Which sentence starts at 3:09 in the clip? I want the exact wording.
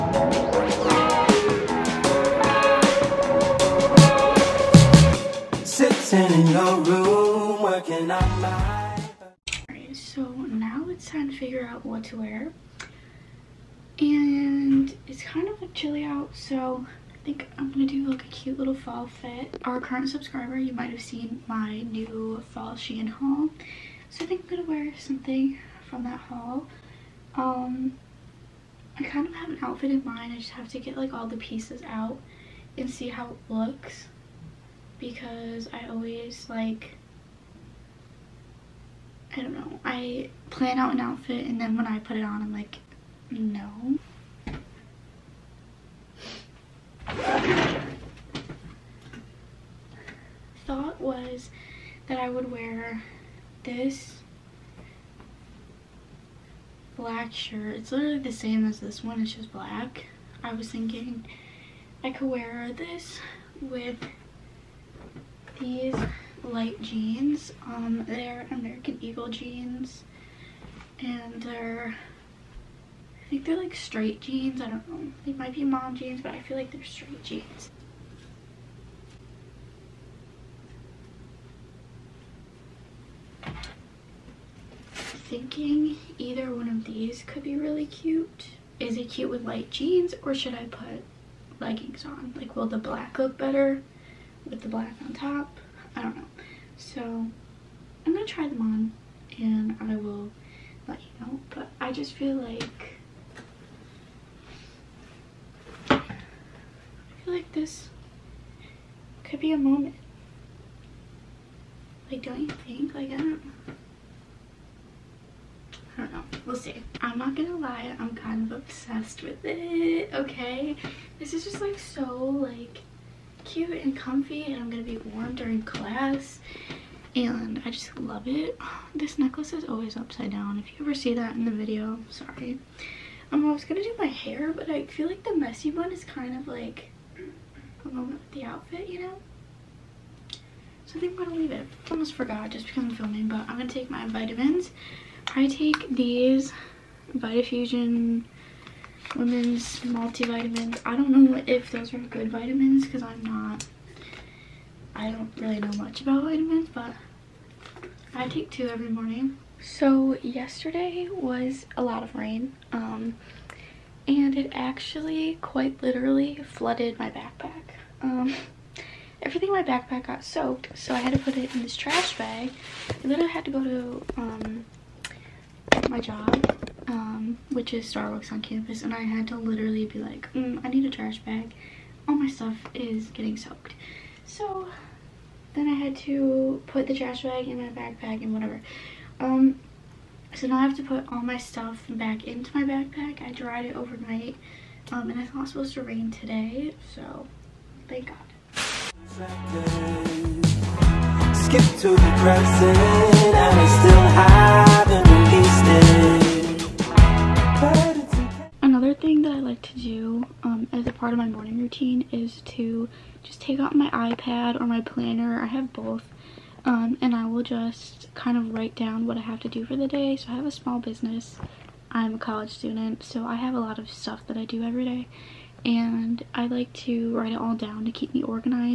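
Um, so now I have to put all my stuff back into my backpack.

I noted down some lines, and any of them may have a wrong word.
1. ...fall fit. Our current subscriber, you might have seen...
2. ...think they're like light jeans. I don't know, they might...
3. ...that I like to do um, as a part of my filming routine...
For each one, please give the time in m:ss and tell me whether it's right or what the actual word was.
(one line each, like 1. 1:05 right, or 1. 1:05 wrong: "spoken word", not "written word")
1. 0:18 right
2. 1:13 wrong: "straight", not "light"
3. 3:29 wrong: "morning", not "filming".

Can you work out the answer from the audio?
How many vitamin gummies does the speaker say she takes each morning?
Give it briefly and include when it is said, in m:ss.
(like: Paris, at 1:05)
2, at 2:38.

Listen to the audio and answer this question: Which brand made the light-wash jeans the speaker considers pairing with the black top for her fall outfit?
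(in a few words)
American Eagle.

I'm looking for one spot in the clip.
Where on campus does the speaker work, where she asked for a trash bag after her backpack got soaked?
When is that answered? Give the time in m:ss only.
2:57.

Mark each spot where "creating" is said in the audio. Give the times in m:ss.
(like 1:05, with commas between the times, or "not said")
not said.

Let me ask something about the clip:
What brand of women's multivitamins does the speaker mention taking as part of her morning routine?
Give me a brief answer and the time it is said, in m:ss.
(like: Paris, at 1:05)
VitaFusion, at 2:27.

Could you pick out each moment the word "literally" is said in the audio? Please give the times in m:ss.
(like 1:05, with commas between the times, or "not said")
0:57, 2:45, 2:53, 2:59.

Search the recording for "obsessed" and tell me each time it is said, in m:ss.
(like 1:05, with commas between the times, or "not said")
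1:58.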